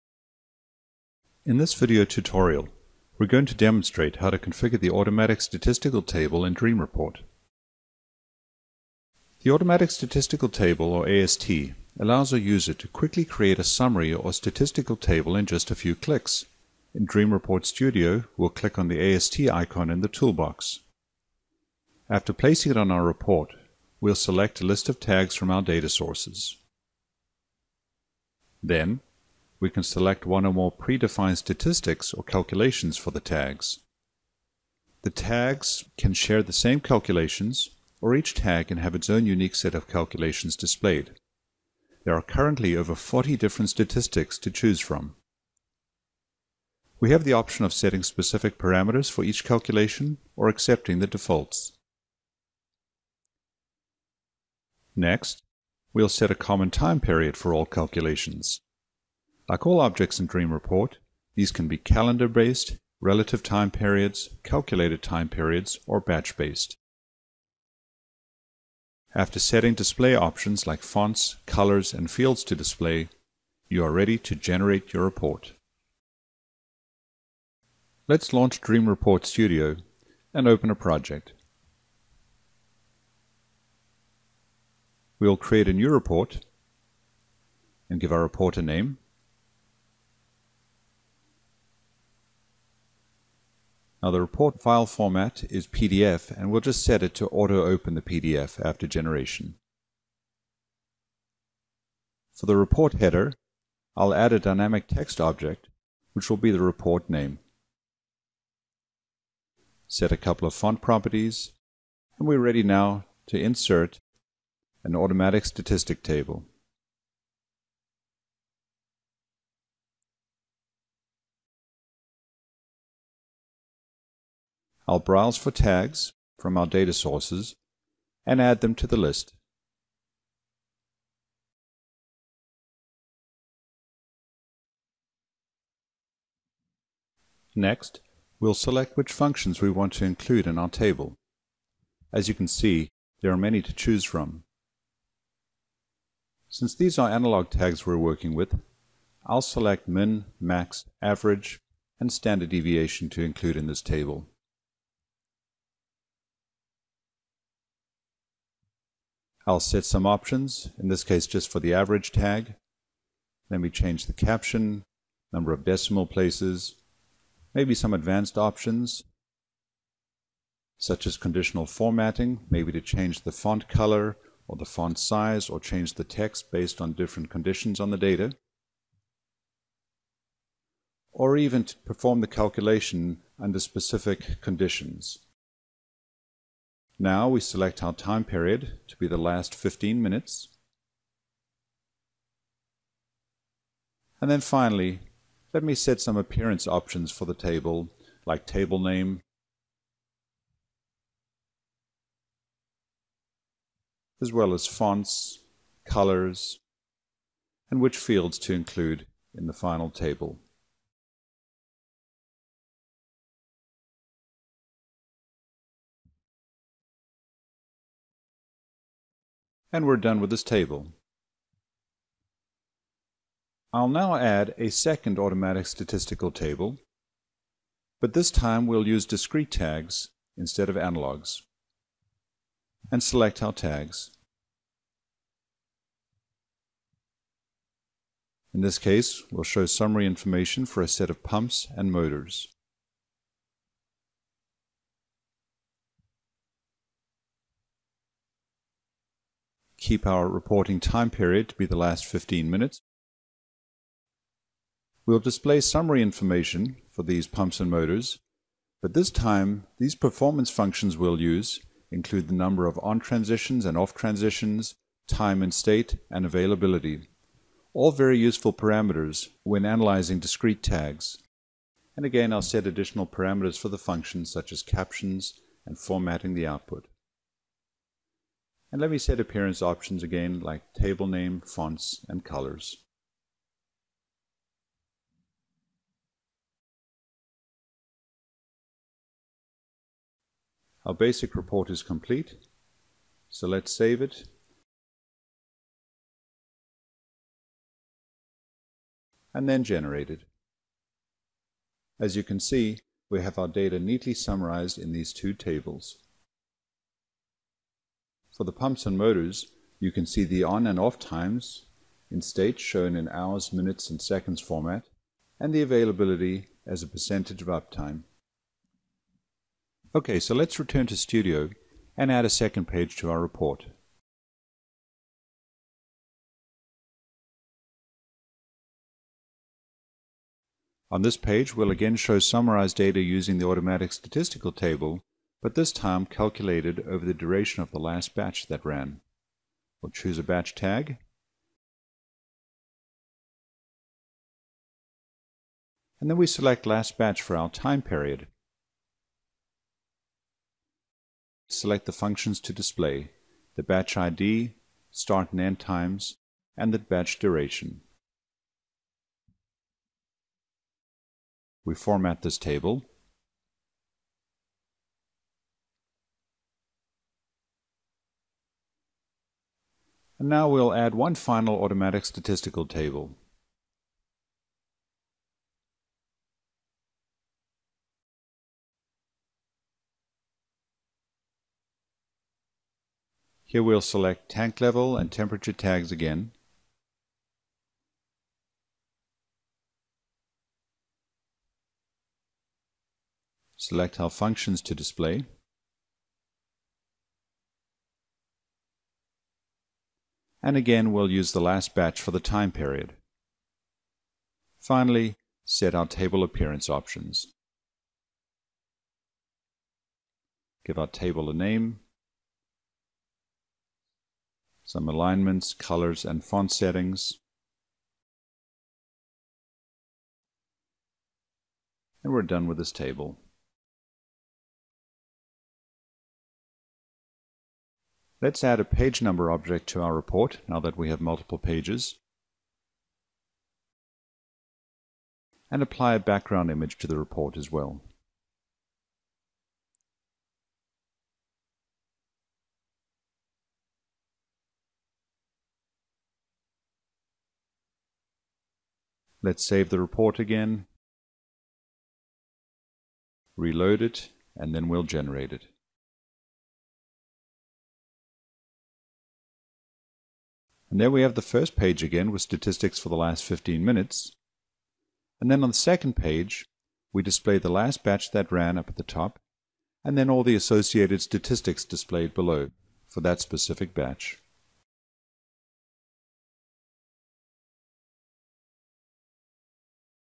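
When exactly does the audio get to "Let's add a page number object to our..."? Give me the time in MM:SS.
07:08.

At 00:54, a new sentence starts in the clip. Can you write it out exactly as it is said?
Next, we'll set a common time period for all calculations.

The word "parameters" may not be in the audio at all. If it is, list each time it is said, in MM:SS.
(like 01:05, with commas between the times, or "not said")
00:48, 04:28, 04:33.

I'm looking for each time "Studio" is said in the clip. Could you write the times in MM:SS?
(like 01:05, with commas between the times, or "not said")
00:17, 01:19, 05:20.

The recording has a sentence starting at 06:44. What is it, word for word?
Finally, set our table appearance options.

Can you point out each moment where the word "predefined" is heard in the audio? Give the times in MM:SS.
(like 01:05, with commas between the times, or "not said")
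00:30.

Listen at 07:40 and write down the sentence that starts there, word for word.
And there we have the first page again with statistics for the last 15 minutes.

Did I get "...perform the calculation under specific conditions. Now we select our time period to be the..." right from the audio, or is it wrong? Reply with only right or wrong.
right.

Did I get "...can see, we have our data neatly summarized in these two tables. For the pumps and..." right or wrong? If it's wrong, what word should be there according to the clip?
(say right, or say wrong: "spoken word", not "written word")
right.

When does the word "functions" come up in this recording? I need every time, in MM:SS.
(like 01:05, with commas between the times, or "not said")
02:19, 04:20, 04:33, 05:51, 06:34.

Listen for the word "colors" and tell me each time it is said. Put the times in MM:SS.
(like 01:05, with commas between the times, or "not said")
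01:11, 02:53, 03:25, 04:42, 06:55.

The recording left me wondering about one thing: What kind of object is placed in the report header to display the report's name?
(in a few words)
dynamic text object.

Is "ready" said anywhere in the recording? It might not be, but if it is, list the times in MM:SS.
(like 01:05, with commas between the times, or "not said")
01:13, 01:52.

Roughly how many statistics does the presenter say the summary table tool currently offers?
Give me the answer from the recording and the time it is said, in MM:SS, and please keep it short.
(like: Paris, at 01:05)
over 40, at 00:42.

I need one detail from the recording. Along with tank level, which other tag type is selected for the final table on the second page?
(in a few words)
temperature.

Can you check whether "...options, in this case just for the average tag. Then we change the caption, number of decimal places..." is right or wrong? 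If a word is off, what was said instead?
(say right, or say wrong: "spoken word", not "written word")
right.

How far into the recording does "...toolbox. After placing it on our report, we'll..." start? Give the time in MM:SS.
00:20.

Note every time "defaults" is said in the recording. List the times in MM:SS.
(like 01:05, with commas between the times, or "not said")
00:51.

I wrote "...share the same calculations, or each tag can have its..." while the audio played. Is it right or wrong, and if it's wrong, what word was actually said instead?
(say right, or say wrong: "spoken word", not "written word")
right.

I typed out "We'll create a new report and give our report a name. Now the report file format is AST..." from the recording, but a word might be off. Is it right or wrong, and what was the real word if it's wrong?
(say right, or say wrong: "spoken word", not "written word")
wrong: "PDF", not "AST".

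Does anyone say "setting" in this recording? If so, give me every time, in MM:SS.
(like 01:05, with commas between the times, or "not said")
00:47, 01:09, 06:56.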